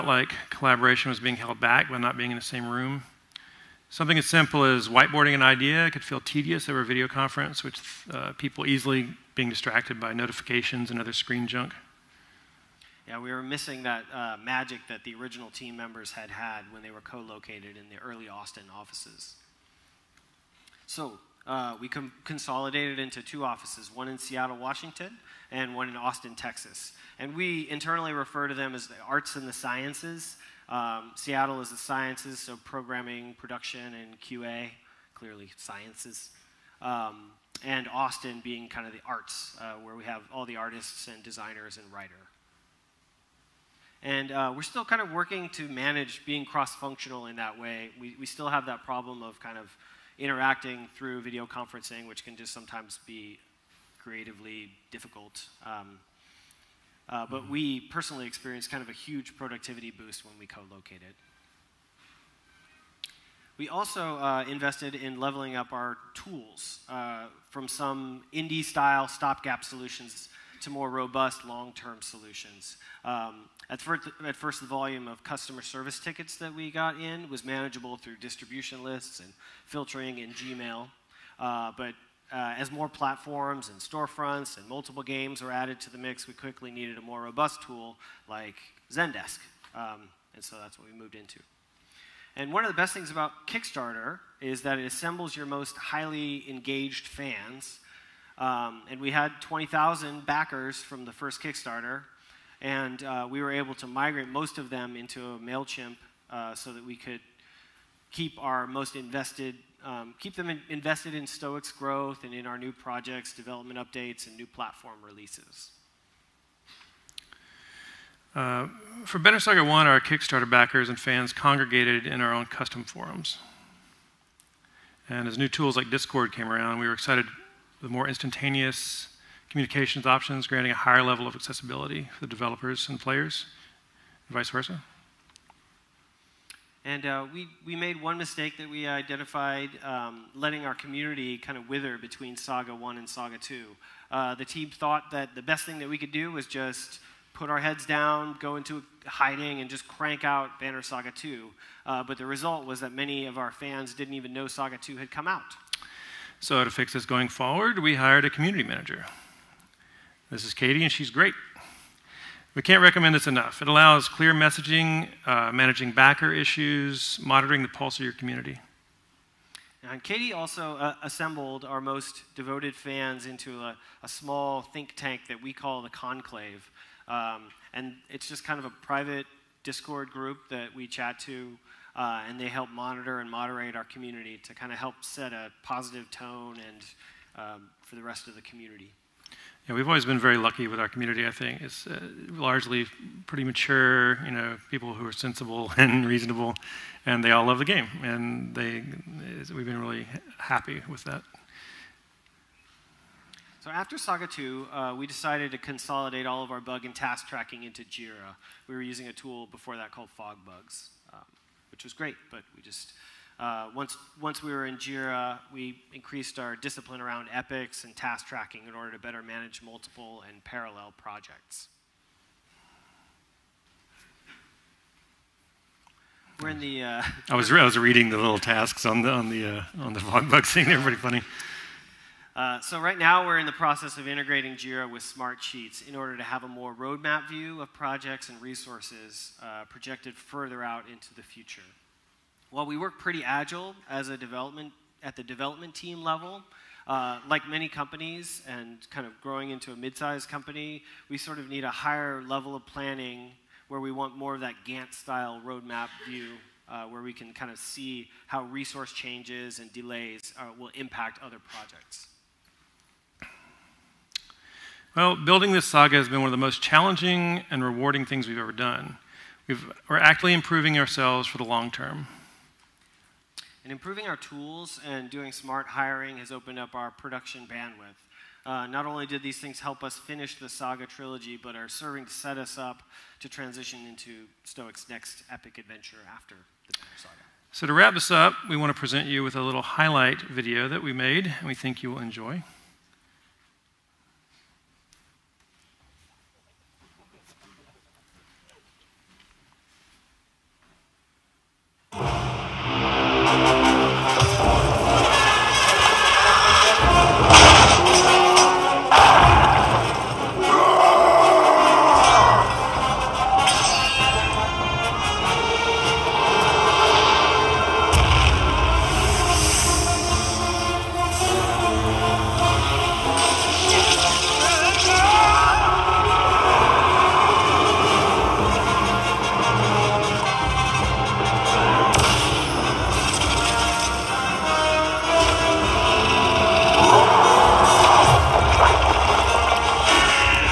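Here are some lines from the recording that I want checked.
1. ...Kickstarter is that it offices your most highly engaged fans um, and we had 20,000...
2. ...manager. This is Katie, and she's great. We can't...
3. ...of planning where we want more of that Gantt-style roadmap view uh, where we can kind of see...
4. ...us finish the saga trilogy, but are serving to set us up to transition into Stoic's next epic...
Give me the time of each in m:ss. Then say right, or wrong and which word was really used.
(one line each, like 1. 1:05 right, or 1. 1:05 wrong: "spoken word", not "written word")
1. 1:33 wrong: "assembles", not "offices"
2. 2:38 right
3. 4:12 right
4. 4:39 right.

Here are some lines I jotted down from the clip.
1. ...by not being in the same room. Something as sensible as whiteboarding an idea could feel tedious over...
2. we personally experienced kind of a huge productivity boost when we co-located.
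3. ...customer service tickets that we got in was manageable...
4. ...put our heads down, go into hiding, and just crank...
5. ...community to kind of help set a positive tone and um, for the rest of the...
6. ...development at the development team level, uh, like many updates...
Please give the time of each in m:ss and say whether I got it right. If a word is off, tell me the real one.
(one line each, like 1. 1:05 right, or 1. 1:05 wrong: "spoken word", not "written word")
1. 0:01 wrong: "simple", not "sensible"
2. 0:57 right
3. 1:15 right
4. 2:27 right
5. 3:03 right
6. 4:04 wrong: "companies", not "updates".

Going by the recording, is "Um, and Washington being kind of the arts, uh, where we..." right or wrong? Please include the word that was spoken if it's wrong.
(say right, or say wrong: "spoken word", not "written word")
wrong: "Austin", not "Washington".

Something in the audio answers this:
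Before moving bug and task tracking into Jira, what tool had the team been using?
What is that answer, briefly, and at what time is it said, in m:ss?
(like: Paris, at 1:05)
FogBugz, at 3:30.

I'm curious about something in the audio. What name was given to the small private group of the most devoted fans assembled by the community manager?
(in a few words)
the Conclave.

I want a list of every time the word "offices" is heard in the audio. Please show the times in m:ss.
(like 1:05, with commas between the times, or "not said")
0:18, 0:23.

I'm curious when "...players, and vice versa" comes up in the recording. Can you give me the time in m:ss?
2:13.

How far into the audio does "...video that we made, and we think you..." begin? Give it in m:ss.
4:50.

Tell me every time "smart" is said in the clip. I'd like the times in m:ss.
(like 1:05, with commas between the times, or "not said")
3:55, 4:35.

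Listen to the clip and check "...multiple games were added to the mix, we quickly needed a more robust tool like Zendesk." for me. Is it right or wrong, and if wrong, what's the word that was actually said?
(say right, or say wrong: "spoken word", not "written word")
right.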